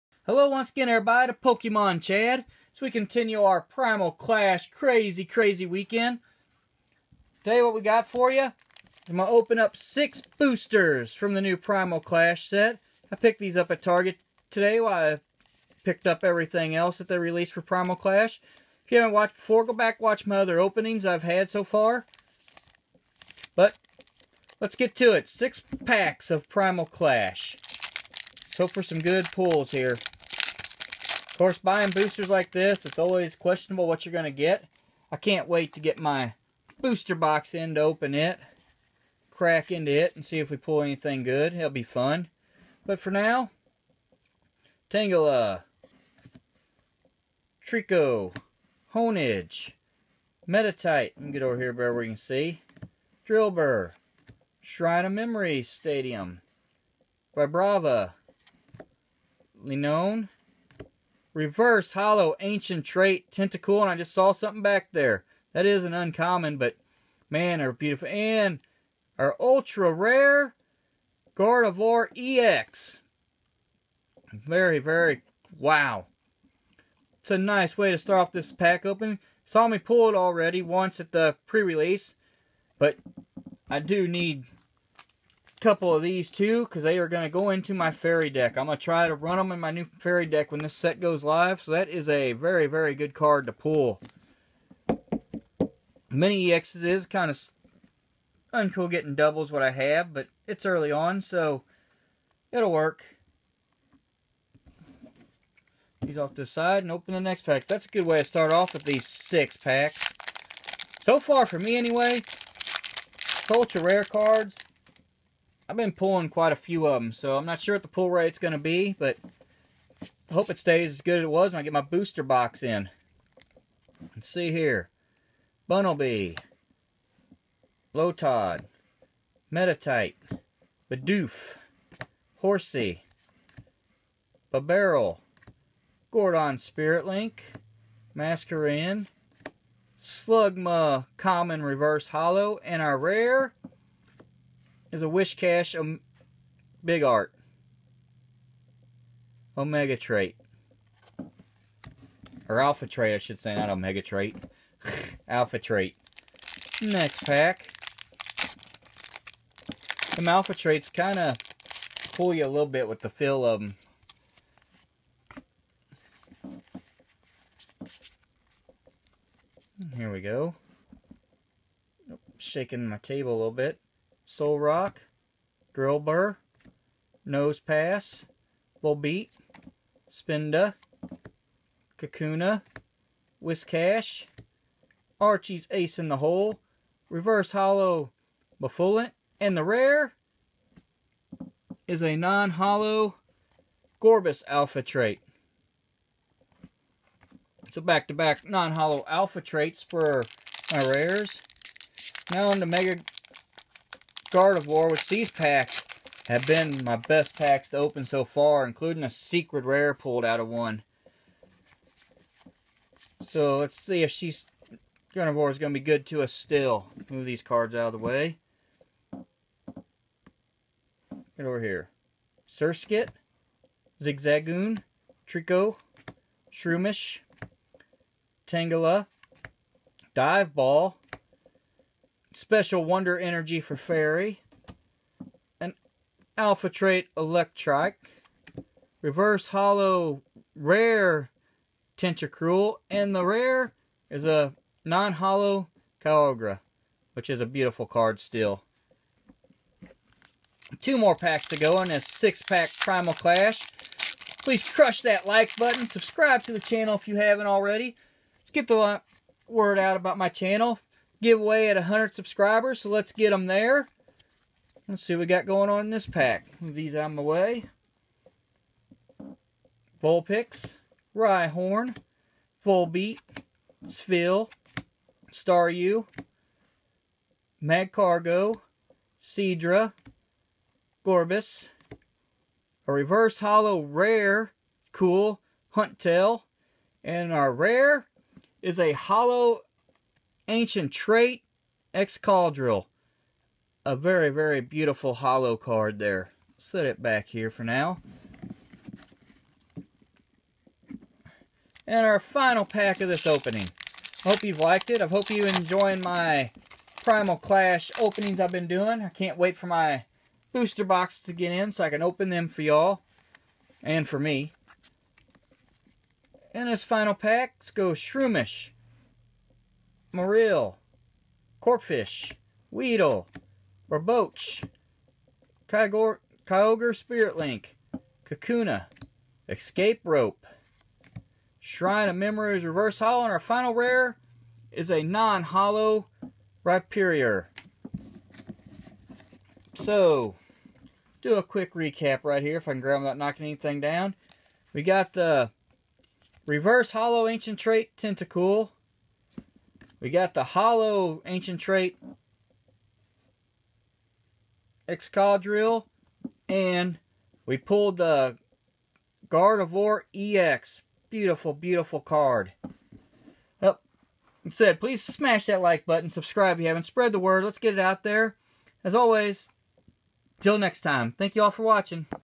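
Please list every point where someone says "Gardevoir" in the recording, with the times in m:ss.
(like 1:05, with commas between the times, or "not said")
1:11, 5:59.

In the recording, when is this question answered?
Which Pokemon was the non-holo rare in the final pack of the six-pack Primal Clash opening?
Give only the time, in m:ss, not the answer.
5:36.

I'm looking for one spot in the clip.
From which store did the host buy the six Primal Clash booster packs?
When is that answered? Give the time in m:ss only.
0:13.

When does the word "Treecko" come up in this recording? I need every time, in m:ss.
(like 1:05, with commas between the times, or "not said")
0:47, 3:45.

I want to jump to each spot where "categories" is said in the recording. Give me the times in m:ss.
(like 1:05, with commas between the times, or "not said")
not said.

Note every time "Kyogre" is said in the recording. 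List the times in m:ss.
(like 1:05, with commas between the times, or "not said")
4:06, 5:25.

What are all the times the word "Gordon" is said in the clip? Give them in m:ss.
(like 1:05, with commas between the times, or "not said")
2:16.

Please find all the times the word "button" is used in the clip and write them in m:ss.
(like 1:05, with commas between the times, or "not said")
4:15, 6:05.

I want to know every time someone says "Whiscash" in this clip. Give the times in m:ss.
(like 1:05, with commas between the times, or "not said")
2:25, 3:03.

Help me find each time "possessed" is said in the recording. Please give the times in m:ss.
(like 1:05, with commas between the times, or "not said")
not said.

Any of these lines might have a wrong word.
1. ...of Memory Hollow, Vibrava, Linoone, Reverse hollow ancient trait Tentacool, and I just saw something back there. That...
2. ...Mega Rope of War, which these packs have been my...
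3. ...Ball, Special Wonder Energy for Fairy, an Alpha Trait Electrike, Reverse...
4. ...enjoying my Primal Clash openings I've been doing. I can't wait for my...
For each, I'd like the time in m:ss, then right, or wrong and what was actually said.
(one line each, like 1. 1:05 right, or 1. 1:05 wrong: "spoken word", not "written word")
1. 0:55 wrong: "Stadium", not "Hollow"
2. 3:22 wrong: "Start", not "Rope"
3. 3:50 right
4. 5:05 right.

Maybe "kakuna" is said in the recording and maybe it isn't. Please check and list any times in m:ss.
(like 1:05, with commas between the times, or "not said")
3:01, 5:28.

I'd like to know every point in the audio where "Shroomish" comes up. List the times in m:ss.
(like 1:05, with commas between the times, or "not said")
3:46, 5:17.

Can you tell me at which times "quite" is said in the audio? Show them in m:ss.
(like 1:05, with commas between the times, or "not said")
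1:56.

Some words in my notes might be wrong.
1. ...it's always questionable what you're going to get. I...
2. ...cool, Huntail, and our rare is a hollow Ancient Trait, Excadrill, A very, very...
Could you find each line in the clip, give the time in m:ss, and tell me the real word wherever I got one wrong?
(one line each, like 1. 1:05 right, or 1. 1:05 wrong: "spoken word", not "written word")
1. 0:32 right
2. 4:44 right.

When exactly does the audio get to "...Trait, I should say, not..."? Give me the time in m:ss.
2:32.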